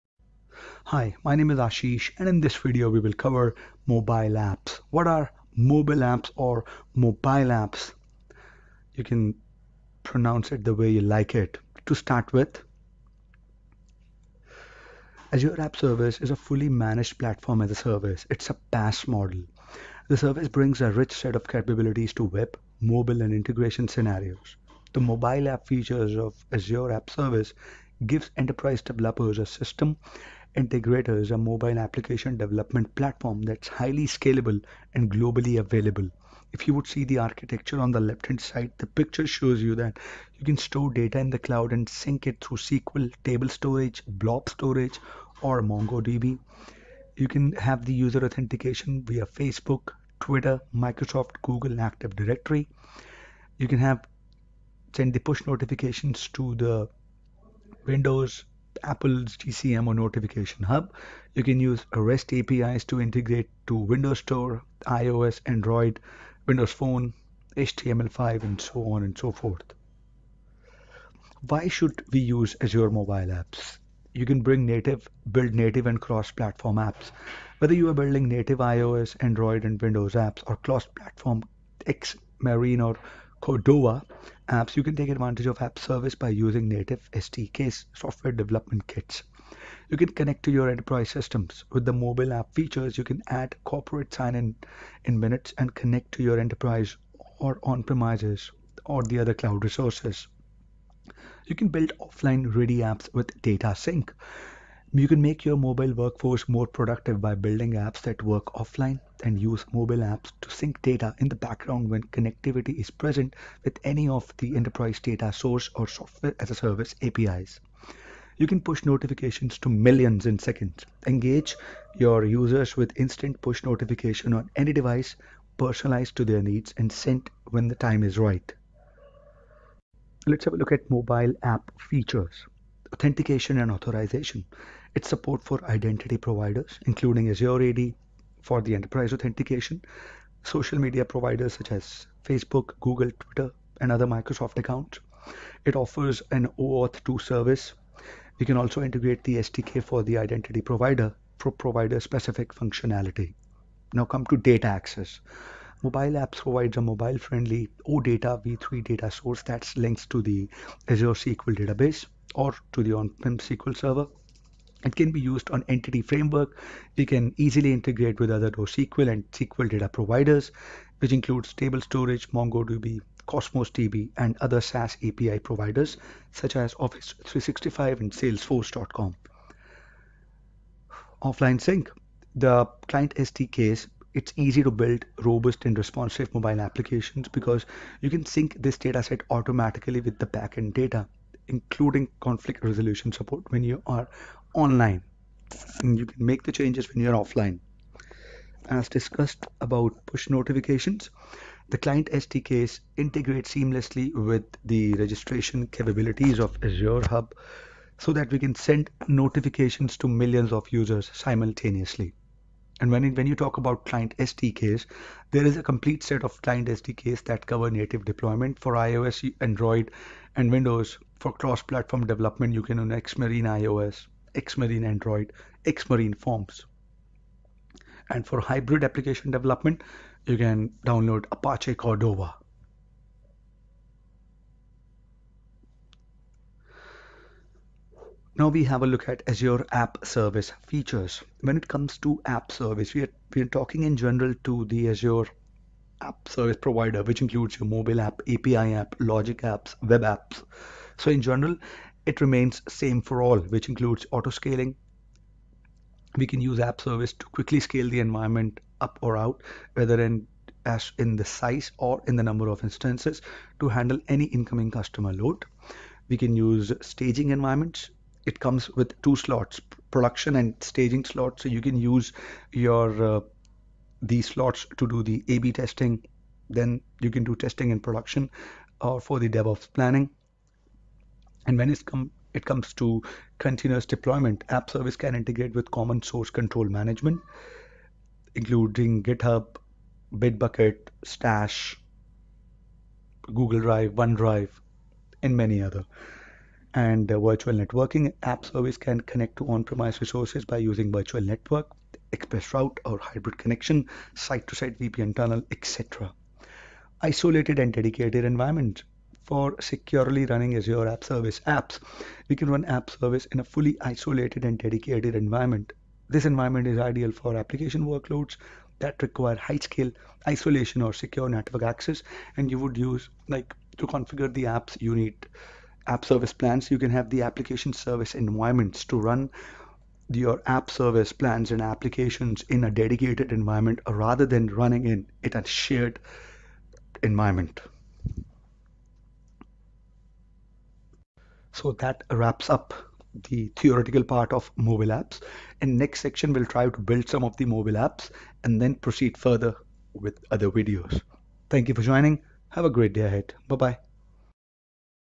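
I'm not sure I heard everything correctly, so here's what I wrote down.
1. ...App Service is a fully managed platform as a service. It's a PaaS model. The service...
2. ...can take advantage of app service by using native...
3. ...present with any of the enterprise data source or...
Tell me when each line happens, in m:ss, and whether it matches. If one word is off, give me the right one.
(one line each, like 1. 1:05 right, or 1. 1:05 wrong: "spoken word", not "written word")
1. 0:15 right
2. 1:24 right
3. 1:52 right.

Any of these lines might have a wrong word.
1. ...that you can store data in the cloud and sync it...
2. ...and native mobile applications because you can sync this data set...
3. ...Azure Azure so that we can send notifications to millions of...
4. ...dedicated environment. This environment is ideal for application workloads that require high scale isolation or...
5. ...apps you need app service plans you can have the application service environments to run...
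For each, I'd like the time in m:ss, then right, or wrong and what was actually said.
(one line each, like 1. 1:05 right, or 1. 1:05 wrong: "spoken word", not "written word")
1. 0:39 right
2. 3:05 wrong: "responsive", not "native"
3. 3:26 wrong: "Hub", not "Azure"
4. 5:14 right
5. 5:24 right.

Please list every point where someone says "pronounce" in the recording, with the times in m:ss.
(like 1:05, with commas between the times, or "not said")
0:10.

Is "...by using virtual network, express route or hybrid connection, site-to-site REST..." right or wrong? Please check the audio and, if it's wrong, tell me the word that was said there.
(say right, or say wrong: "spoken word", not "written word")
wrong: "VPN", not "REST".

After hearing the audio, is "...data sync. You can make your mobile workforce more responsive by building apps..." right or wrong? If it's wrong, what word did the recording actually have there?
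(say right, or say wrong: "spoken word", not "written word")
wrong: "productive", not "responsive".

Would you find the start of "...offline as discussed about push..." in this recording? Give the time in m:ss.
3:17.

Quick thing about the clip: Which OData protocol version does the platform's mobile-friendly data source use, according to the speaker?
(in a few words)
v3.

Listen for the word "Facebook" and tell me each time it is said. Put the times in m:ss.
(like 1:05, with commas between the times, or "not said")
0:49, 2:22.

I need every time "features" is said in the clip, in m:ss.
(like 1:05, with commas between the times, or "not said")
0:25, 1:32, 2:11, 4:00.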